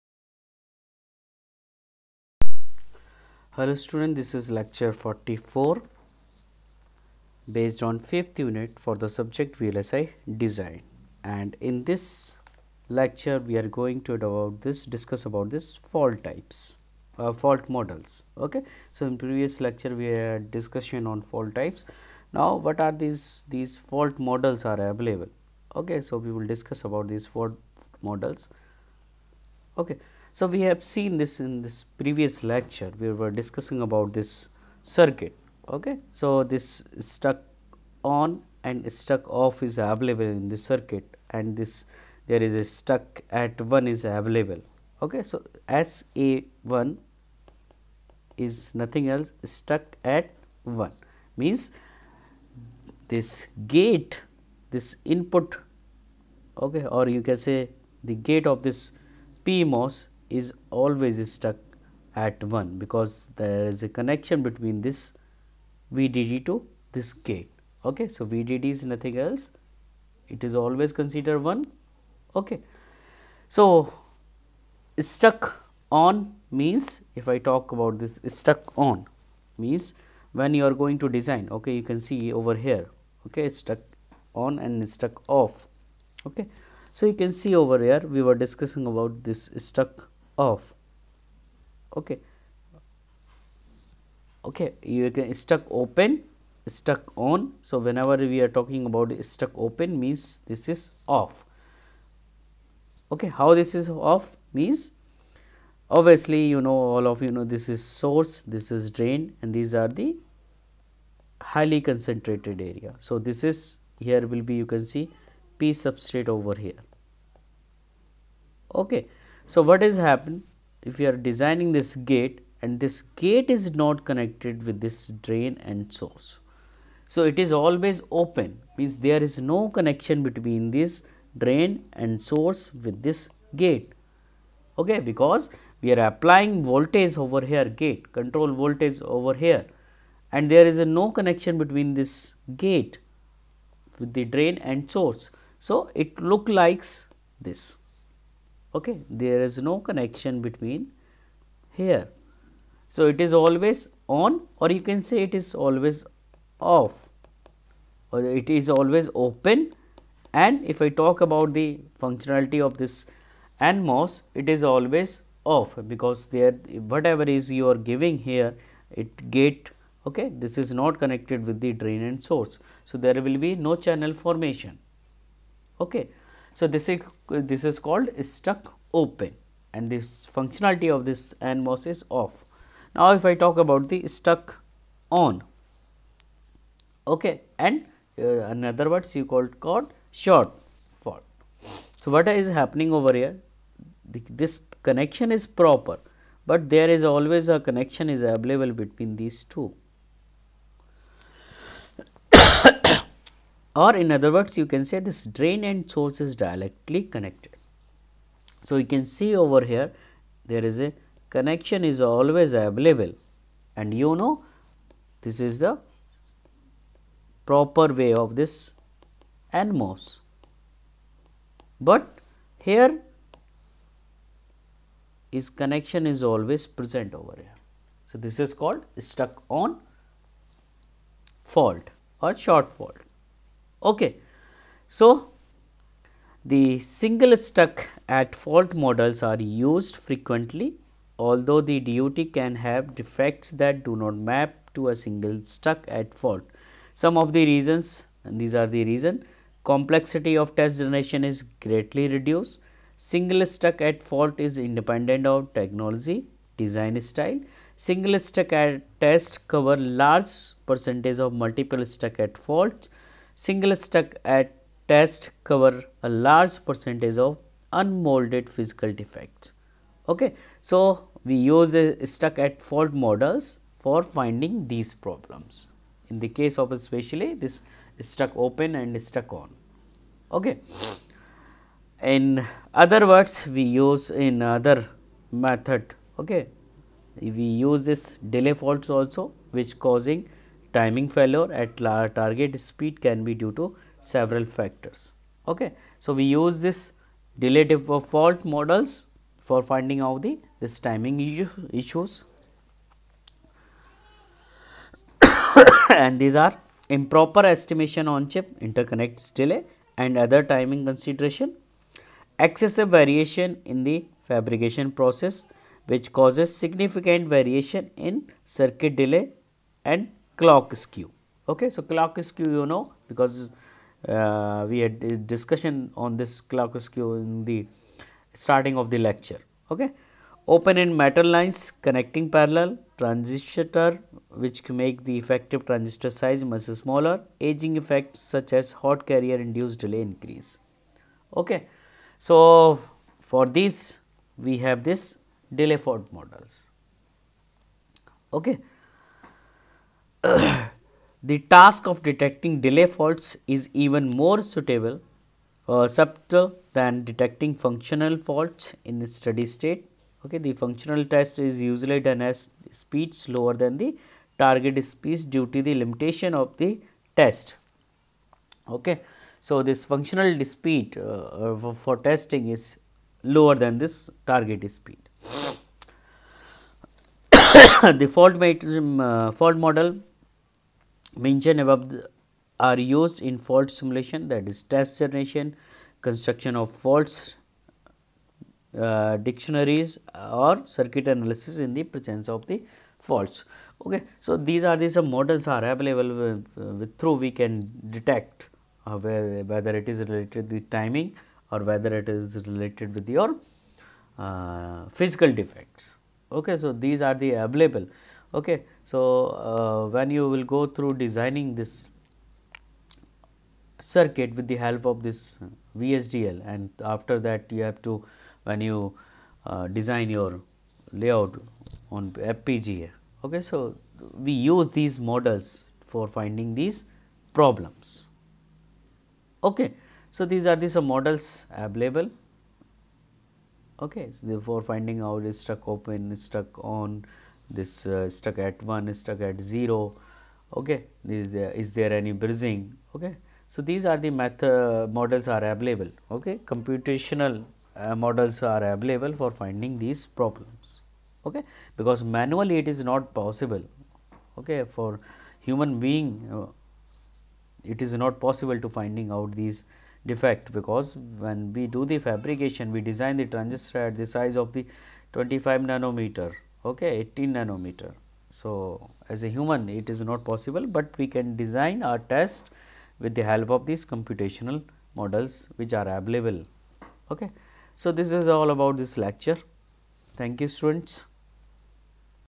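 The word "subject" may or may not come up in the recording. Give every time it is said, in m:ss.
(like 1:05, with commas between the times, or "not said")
0:09.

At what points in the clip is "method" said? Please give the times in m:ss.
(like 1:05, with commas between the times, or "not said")
4:45, 7:24.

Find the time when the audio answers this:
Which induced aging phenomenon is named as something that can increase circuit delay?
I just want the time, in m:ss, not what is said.
5:38.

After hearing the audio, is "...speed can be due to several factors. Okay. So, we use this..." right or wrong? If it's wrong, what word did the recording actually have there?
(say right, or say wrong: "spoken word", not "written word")
right.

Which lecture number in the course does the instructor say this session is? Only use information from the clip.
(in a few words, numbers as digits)
44.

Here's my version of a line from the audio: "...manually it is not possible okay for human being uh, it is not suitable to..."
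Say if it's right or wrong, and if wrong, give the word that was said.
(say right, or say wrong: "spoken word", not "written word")
wrong: "possible", not "suitable".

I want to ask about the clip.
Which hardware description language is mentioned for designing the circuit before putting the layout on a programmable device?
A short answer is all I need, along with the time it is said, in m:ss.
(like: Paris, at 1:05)
VHDL, at 6:55.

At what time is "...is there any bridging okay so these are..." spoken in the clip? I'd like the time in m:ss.
7:21.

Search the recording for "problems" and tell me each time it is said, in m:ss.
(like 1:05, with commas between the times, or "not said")
4:34, 7:07, 7:30.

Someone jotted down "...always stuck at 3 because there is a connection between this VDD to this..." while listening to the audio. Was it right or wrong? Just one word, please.
wrong.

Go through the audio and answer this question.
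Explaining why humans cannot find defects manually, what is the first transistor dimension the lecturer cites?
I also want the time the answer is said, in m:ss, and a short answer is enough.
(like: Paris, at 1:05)
25 nanometer, at 7:45.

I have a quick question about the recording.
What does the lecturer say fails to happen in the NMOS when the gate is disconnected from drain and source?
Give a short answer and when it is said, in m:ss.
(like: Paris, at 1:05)
channel formation, at 2:53.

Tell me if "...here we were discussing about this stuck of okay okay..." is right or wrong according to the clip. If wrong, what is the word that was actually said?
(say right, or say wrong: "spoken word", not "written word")
right.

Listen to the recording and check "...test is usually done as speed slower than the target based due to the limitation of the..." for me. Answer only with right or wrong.
wrong.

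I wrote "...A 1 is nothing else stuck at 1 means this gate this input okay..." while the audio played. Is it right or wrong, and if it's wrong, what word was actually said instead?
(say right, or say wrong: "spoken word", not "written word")
right.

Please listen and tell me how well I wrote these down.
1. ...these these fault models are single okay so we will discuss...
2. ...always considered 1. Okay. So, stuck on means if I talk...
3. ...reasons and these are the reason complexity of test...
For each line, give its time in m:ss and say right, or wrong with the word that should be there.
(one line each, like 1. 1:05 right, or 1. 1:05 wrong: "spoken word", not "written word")
1. 0:22 wrong: "available", not "single"
2. 1:10 right
3. 4:07 right.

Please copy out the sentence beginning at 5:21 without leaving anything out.
Okay, so clock skew you know because uh, we had a discussion on this clock skew in the starting of the lecture.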